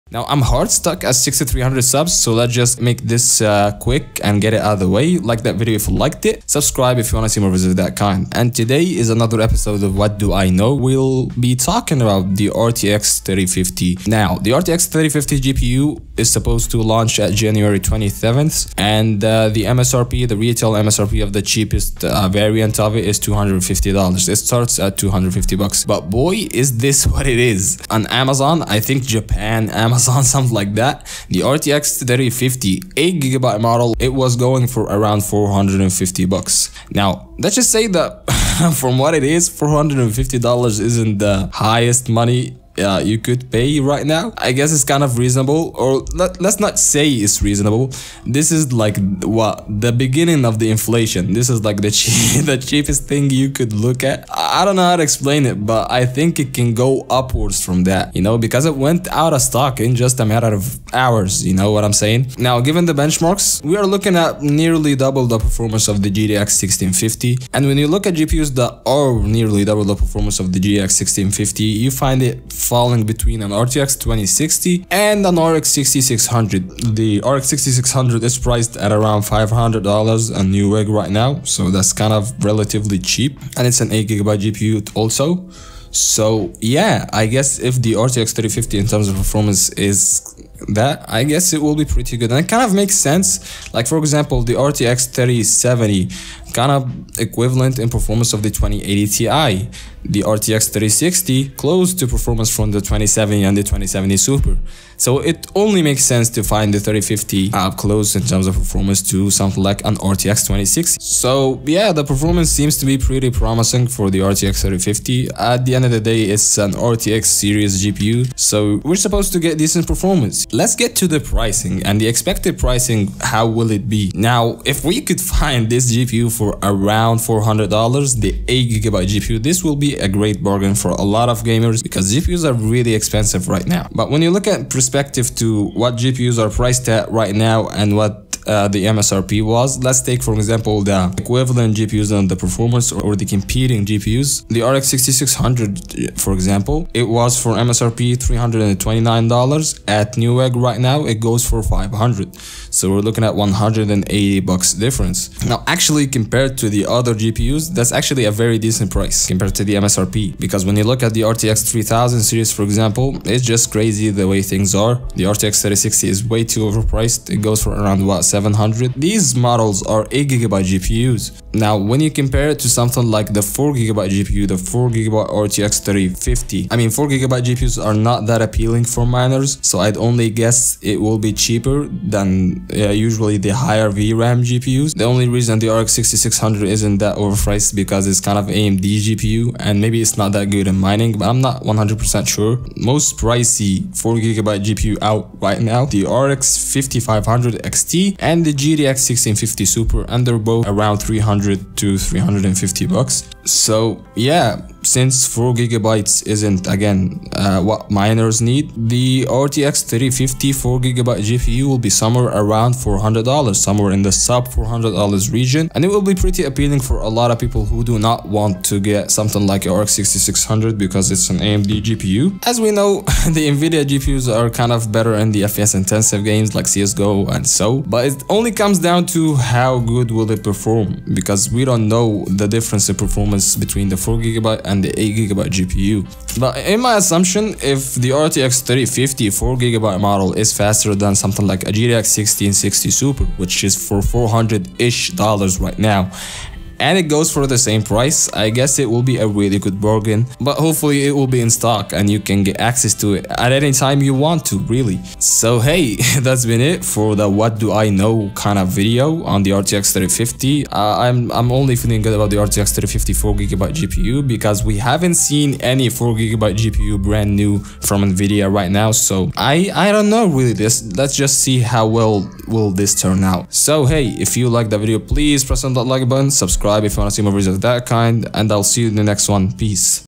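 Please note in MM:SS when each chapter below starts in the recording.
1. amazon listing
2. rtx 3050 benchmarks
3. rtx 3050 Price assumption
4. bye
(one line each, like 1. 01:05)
1. 00:25
2. 01:00
3. 02:00
4. 04:33.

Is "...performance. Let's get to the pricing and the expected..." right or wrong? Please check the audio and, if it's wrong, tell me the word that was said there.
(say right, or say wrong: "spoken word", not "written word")
right.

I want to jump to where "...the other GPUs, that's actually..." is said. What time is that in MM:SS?
02:36.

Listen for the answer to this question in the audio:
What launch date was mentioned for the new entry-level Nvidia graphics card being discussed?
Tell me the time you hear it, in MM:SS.
00:17.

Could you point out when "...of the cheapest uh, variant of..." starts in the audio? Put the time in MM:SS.
00:21.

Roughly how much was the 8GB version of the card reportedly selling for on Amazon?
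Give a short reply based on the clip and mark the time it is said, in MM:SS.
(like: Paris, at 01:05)
$450, at 00:35.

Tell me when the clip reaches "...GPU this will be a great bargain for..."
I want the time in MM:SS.
02:09.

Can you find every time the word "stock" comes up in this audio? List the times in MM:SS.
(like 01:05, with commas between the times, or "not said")
00:59, 04:11.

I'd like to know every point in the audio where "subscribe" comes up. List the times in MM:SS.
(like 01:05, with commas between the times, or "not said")
00:06, 04:36.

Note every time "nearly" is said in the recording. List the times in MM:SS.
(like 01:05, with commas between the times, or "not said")
01:04, 01:09.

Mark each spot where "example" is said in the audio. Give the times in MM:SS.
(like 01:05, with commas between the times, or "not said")
01:33, 02:20, 02:26, 02:42.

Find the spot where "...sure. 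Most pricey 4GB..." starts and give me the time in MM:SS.
03:12.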